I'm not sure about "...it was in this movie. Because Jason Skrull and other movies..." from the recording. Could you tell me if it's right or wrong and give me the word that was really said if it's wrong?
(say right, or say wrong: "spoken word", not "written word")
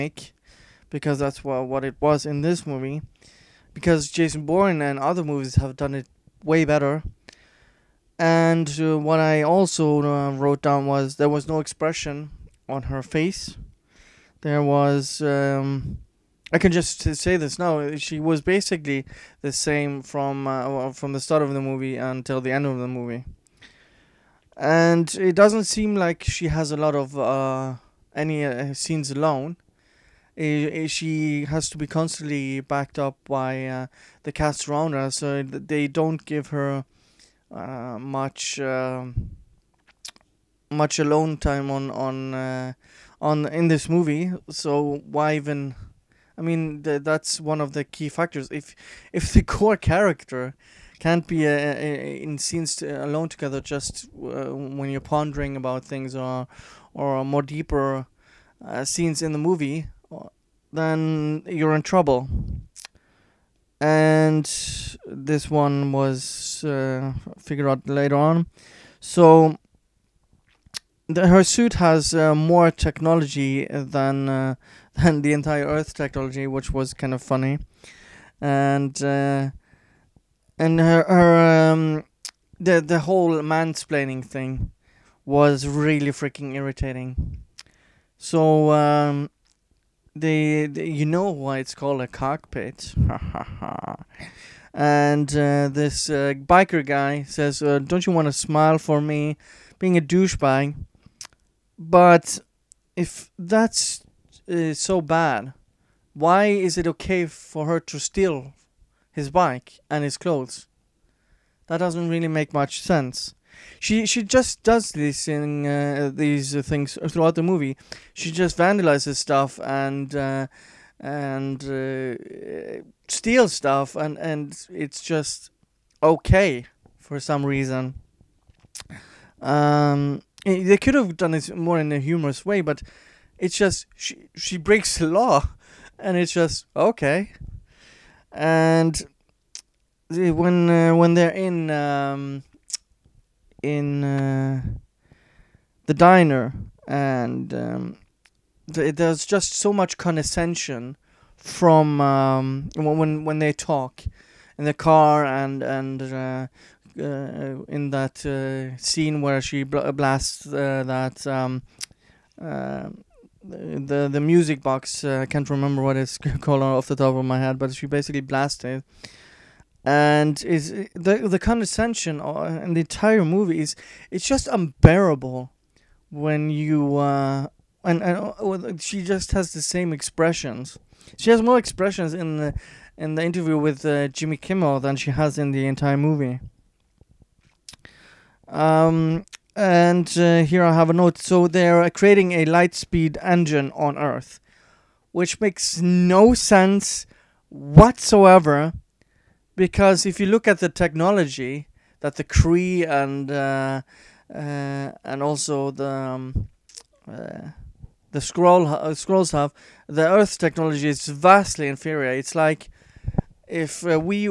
wrong: "Bourne", not "Skrull".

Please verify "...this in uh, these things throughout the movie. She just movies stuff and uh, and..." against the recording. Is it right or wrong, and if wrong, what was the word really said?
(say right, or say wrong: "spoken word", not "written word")
wrong: "vandalizes", not "movies".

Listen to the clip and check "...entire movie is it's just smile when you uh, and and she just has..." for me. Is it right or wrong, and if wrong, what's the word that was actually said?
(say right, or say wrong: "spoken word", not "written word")
wrong: "unbearable", not "smile".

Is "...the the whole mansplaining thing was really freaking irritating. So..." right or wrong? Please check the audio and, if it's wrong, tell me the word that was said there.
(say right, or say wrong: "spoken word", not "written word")
right.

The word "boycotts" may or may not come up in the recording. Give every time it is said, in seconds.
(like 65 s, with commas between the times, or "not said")
not said.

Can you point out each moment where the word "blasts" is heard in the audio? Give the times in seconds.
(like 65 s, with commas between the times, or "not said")
159 s, 168 s.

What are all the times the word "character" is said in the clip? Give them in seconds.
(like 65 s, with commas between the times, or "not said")
49 s.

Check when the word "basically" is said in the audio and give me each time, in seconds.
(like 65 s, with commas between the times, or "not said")
18 s, 167 s.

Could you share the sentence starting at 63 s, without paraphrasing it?
And this one was figured out later on.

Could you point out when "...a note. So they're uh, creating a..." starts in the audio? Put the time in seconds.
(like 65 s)
190 s.